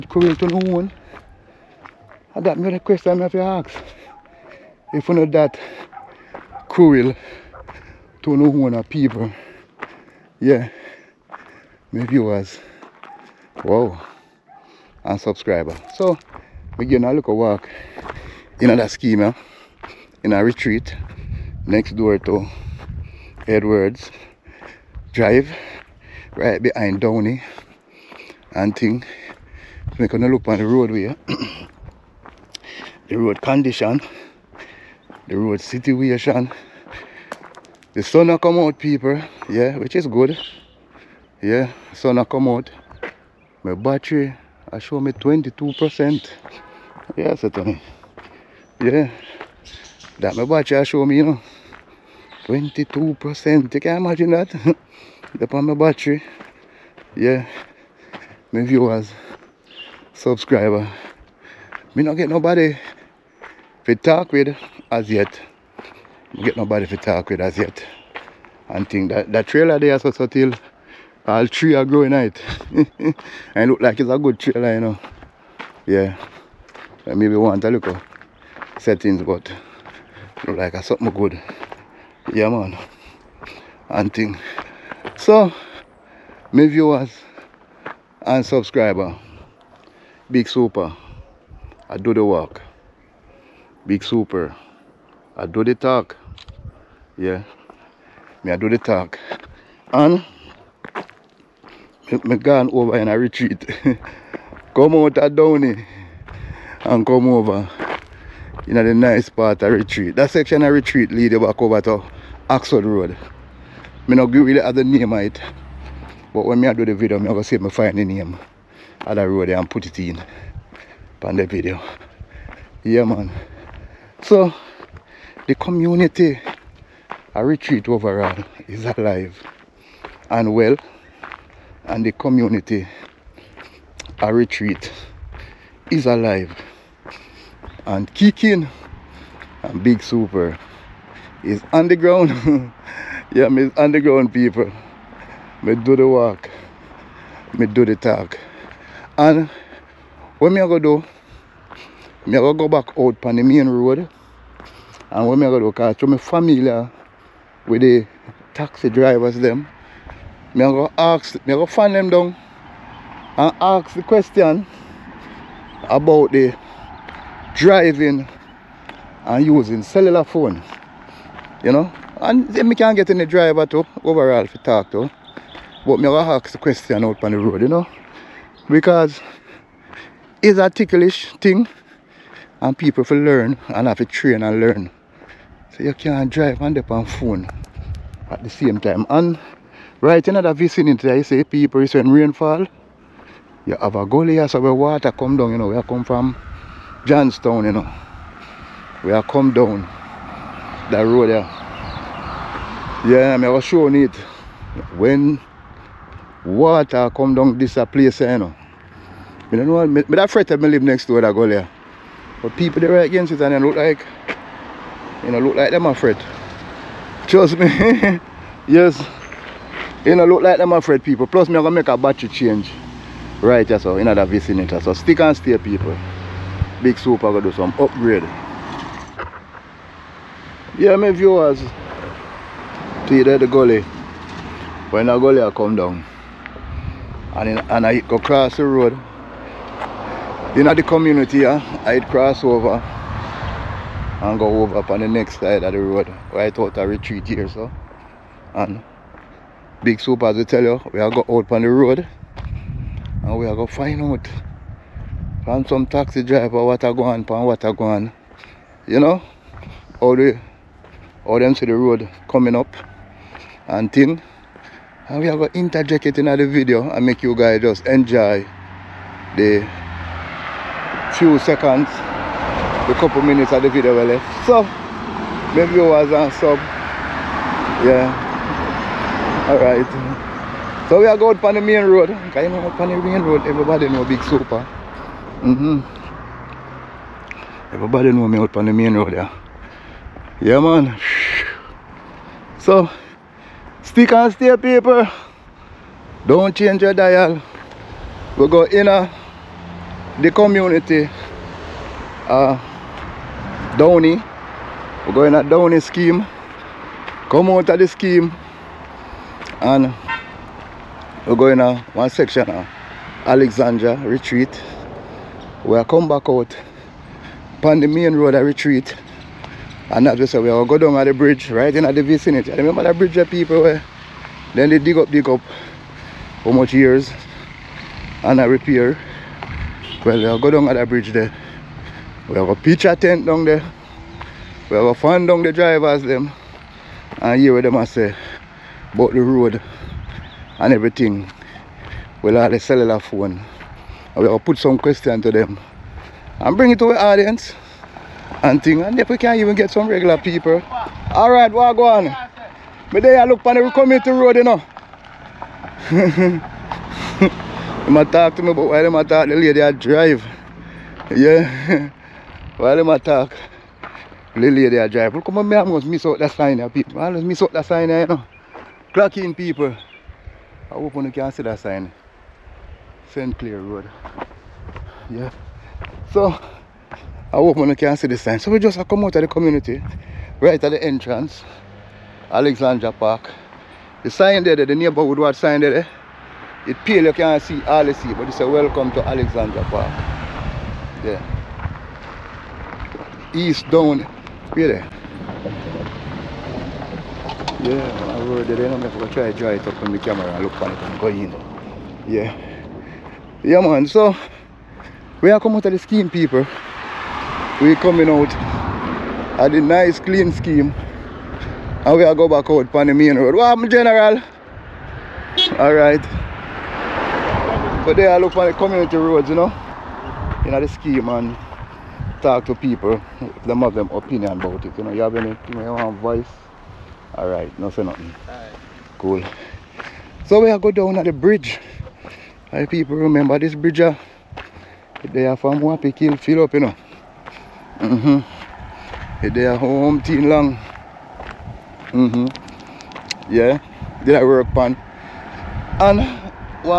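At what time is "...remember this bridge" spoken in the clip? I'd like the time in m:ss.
7:12.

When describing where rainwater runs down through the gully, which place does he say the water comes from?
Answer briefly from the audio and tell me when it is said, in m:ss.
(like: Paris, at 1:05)
Johnstown, at 3:17.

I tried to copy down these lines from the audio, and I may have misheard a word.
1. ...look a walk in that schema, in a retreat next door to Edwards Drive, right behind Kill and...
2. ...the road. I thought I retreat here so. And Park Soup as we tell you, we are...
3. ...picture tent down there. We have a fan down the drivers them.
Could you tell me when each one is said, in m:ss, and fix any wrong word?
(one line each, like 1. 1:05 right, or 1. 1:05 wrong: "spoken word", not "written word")
1. 0:17 wrong: "Downie", not "Kill"
2. 4:05 wrong: "Big", not "Park"
3. 5:32 right.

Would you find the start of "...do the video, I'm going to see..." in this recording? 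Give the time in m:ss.
1:56.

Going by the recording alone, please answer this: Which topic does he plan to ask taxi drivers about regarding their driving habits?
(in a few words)
using cellular phone.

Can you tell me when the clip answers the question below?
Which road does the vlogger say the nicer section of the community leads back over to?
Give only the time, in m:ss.
1:52.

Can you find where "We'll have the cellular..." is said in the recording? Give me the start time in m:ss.
5:42.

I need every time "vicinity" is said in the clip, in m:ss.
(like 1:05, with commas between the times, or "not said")
3:10, 3:44, 5:22.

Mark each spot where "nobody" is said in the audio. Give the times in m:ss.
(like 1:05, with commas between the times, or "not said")
1:02, 1:06.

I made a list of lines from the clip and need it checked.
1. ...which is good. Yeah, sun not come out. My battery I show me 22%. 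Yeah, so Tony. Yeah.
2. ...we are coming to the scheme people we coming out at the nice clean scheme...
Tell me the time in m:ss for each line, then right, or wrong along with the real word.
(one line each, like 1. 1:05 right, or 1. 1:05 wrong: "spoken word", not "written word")
1. 0:39 right
2. 6:45 right.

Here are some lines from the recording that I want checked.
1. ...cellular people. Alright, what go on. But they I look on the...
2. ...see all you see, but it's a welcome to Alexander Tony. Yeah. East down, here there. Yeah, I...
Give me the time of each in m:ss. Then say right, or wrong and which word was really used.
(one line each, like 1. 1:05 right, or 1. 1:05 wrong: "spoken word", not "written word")
1. 5:49 wrong: "regular", not "cellular"
2. 6:27 wrong: "Park", not "Tony".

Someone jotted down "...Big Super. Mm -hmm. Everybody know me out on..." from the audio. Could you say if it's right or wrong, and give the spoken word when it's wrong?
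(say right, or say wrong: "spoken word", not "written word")
right.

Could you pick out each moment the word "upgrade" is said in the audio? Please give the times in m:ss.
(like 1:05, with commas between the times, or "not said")
3:47.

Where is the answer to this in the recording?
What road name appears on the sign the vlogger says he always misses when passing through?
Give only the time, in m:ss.
6:13.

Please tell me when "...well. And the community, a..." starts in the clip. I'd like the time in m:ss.
2:10.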